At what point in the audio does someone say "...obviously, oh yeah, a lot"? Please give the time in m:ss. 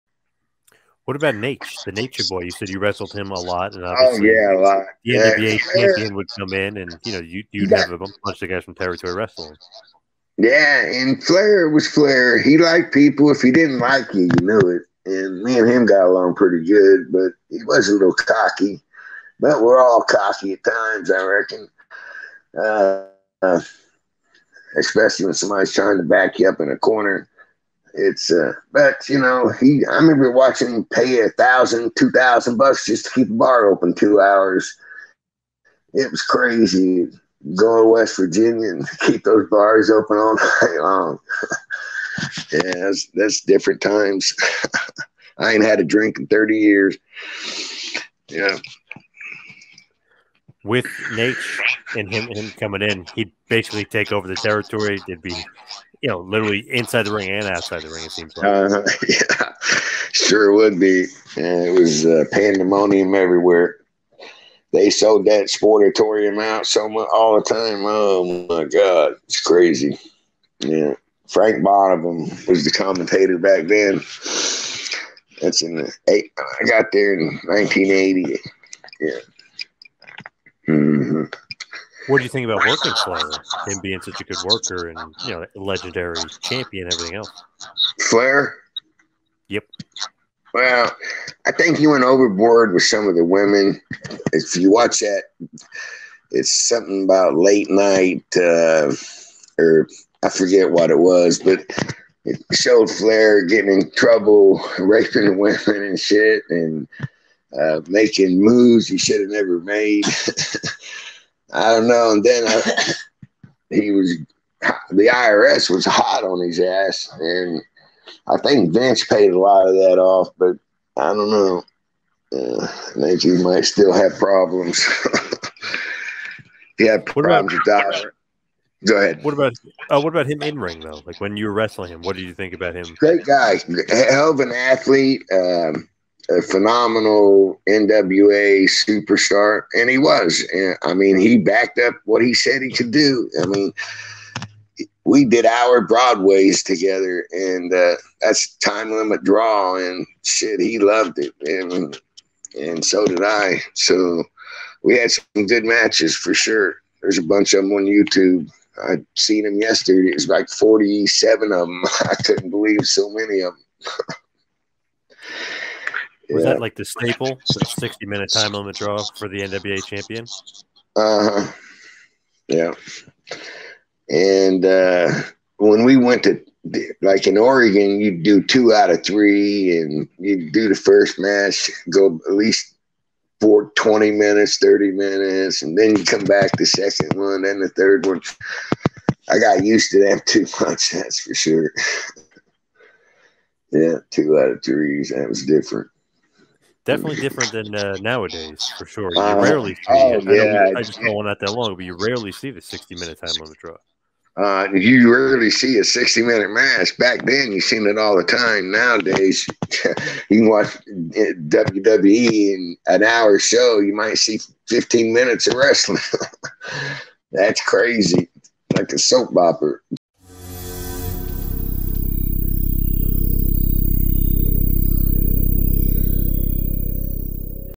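0:03.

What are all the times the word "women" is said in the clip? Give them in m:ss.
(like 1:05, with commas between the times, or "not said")
1:33, 1:45.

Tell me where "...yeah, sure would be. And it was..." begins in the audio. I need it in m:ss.
0:59.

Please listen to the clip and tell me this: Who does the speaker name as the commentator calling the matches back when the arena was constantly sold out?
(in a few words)
Frank Bonnema.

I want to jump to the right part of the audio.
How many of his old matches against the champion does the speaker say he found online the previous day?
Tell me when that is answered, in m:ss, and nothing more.
2:40.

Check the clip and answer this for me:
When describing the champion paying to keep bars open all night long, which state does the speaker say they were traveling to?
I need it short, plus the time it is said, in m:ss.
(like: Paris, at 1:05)
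West Virginia, at 0:37.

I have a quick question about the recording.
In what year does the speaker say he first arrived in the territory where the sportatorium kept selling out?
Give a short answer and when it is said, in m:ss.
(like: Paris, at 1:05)
1980, at 1:17.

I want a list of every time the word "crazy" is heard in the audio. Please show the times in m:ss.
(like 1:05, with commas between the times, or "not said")
0:36, 1:09, 3:37.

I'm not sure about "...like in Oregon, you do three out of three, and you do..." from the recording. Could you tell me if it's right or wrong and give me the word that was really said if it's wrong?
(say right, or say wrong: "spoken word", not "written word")
wrong: "two", not "three".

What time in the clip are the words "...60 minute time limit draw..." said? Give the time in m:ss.
2:47.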